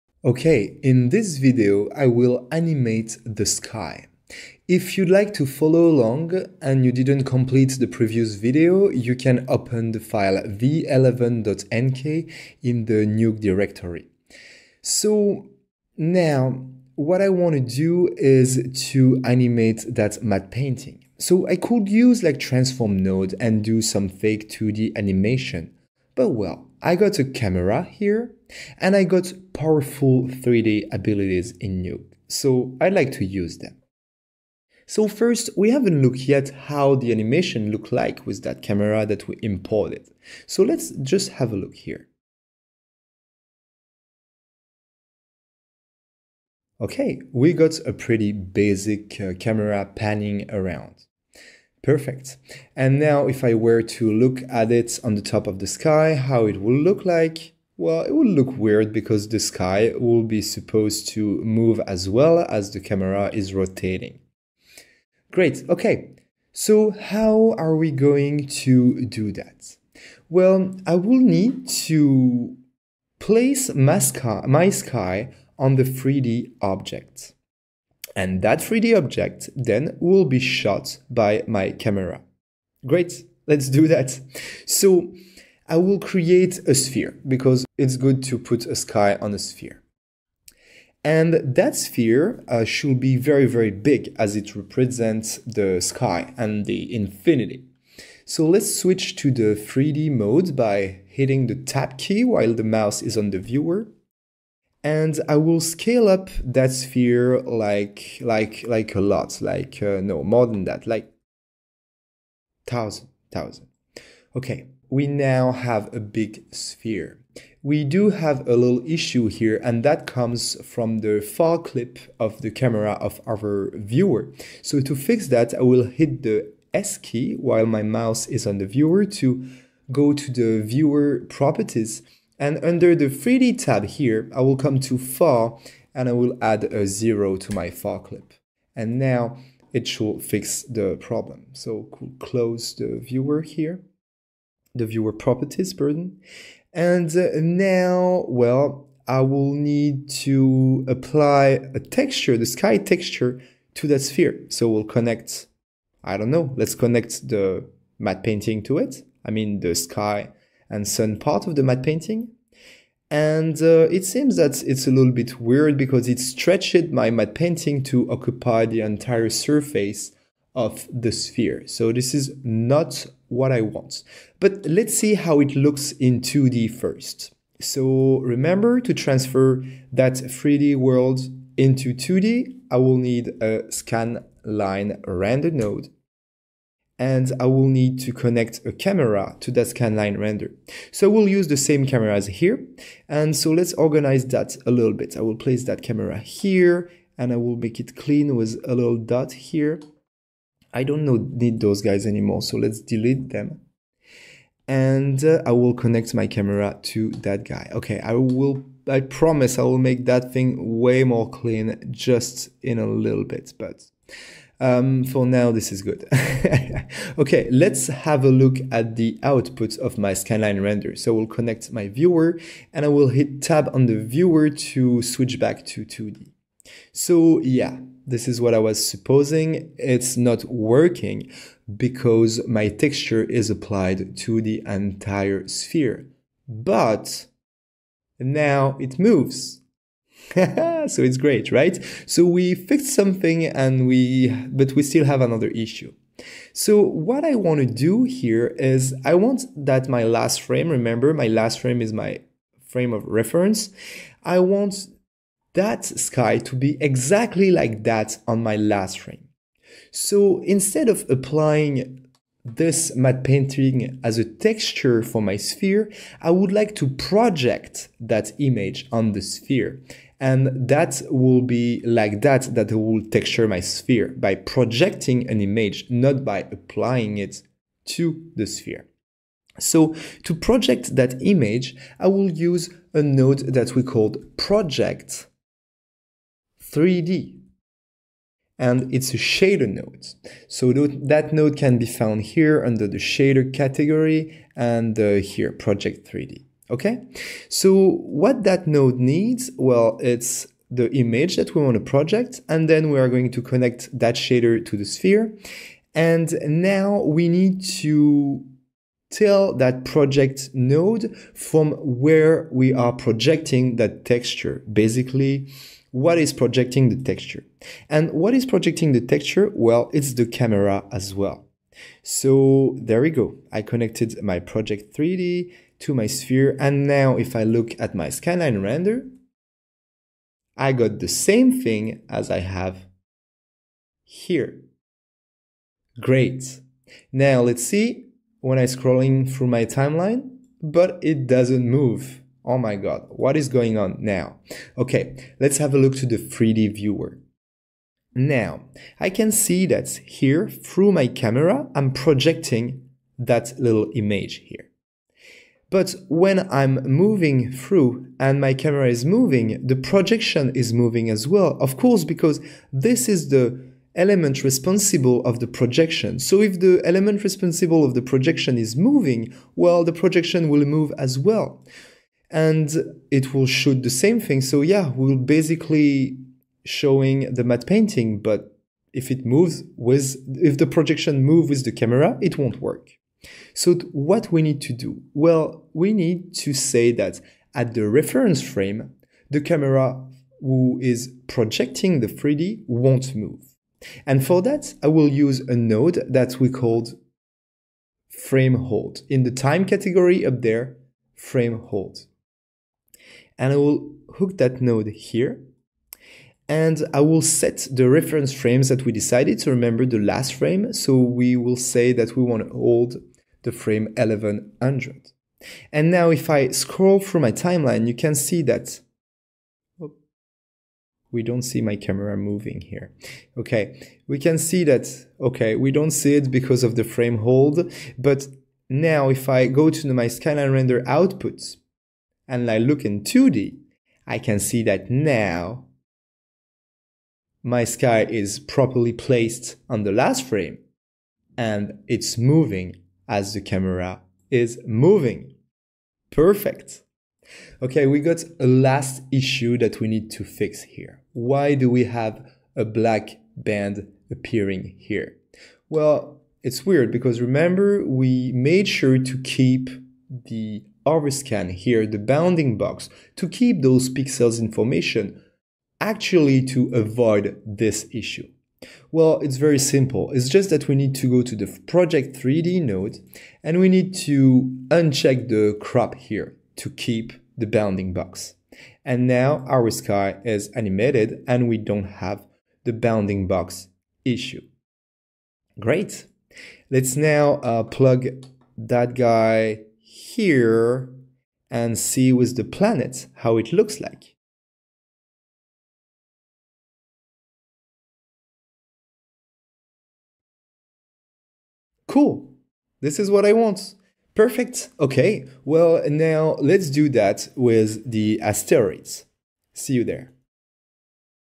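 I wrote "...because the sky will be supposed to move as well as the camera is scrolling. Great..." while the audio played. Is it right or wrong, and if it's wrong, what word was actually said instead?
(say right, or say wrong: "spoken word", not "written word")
wrong: "rotating", not "scrolling".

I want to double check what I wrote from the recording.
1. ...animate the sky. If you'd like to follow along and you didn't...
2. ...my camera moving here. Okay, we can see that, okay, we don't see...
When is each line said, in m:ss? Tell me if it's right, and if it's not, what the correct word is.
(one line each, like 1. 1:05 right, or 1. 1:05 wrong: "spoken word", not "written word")
1. 0:02 right
2. 7:01 right.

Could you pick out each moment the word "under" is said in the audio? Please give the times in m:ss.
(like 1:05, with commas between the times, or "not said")
2:12, 4:52.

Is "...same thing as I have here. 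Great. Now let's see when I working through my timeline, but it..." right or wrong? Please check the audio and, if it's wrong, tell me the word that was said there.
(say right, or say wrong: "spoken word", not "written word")
wrong: "scrolling", not "working".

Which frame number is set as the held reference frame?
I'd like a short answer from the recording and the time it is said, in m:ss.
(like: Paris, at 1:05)
1100, at 6:53.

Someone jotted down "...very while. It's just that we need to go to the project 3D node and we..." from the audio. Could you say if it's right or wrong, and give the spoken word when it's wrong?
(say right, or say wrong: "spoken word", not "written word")
wrong: "simple", not "while".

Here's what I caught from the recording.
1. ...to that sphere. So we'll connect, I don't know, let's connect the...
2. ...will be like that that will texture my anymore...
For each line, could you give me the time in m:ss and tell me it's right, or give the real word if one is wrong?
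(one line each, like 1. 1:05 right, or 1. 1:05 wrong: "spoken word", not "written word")
1. 2:33 right
2. 4:31 wrong: "sphere", not "anymore".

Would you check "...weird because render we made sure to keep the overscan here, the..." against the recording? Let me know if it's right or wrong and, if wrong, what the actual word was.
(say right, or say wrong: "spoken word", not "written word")
wrong: "remember", not "render".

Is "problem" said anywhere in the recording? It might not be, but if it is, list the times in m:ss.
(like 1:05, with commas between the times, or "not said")
2:20.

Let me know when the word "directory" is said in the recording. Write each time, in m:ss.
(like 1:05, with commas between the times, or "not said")
0:13.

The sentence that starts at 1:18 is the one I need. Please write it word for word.
And that 3D object then will be shot by my camera.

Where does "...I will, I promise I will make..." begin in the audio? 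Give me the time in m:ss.
3:27.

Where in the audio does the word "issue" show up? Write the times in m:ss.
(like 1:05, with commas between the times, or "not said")
1:58, 4:05, 7:29, 7:47, 8:04.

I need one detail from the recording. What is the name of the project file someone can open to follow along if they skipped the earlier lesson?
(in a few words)
v11.nk.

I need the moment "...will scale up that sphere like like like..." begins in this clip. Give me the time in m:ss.
1:45.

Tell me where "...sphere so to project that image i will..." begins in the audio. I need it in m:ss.
4:38.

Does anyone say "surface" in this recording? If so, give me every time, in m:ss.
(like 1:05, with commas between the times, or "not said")
2:49.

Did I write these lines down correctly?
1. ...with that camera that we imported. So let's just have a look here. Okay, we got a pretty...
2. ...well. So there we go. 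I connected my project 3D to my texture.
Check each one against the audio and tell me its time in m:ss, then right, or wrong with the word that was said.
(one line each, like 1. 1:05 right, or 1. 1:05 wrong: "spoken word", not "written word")
1. 0:38 right
2. 5:21 wrong: "sphere", not "texture".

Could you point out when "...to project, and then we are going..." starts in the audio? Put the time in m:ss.
5:01.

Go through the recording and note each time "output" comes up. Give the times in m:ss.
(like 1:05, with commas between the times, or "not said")
3:39, 7:10.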